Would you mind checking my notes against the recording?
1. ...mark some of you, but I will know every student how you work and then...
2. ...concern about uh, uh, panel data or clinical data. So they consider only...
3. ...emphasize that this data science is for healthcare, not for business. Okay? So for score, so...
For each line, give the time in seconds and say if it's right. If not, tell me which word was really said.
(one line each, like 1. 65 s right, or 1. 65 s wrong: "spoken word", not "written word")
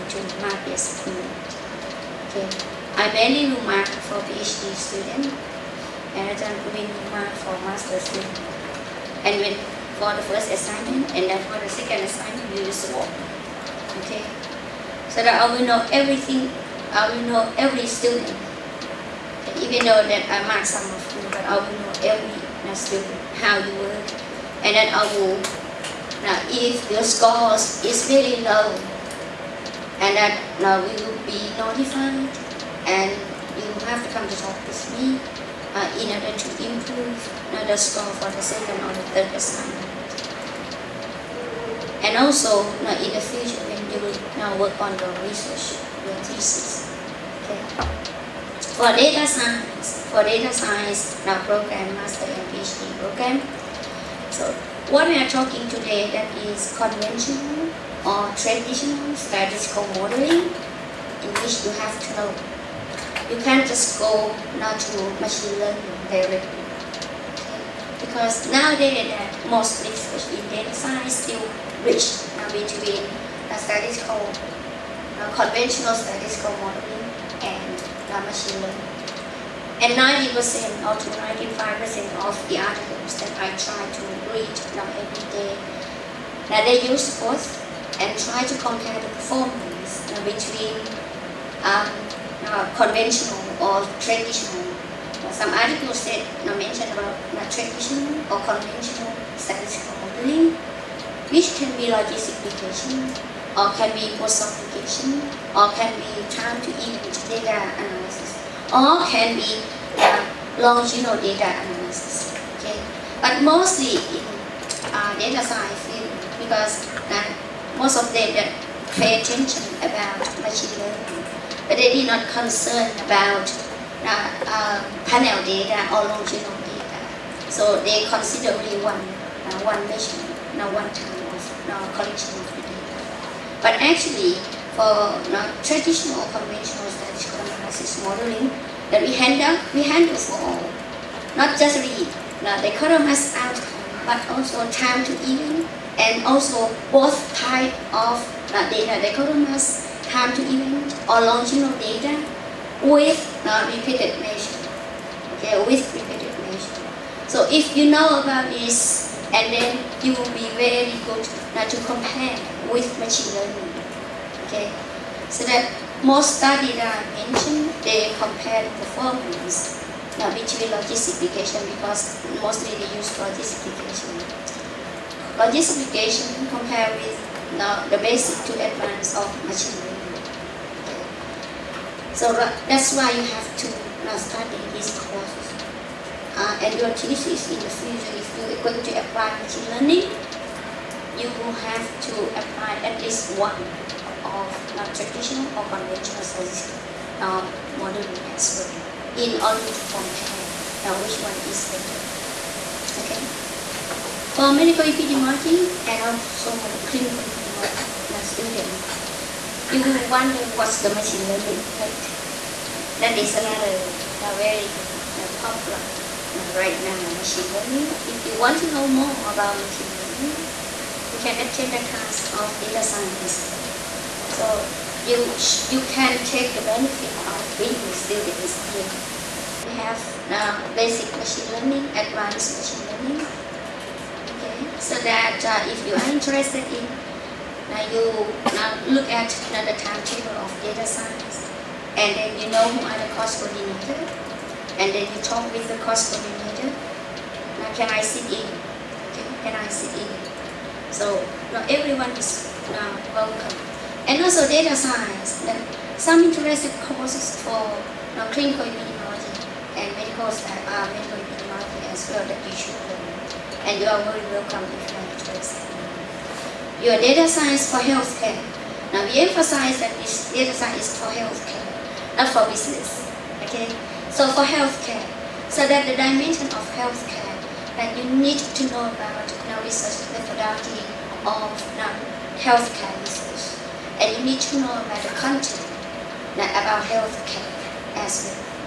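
1. 20 s right
2. 122 s wrong: "longitudinal", not "clinical"
3. 269 s wrong: "healthcare", not "score".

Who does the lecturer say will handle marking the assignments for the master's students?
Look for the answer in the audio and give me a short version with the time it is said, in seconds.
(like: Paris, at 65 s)
Ajahn Praveen, at 6 s.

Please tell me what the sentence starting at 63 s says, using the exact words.
You can't just go now to machine learning directly.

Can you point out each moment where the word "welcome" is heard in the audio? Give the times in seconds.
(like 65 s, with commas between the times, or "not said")
253 s, 264 s.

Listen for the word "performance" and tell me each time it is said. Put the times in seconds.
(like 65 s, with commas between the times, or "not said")
89 s, 168 s.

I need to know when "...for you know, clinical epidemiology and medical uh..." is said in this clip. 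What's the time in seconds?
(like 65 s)
257 s.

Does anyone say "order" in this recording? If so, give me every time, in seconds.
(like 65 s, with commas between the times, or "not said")
36 s, 199 s.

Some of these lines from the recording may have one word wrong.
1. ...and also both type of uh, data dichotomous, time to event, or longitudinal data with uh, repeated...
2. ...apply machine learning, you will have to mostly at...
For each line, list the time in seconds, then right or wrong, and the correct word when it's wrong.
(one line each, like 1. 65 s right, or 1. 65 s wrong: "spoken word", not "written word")
1. 145 s right
2. 188 s wrong: "apply", not "mostly".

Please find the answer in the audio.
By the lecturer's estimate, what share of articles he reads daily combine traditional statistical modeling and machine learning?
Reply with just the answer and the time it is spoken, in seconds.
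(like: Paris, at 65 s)
90% to 95%, at 79 s.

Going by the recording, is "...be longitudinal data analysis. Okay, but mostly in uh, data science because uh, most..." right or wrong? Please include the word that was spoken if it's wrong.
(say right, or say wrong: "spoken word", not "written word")
right.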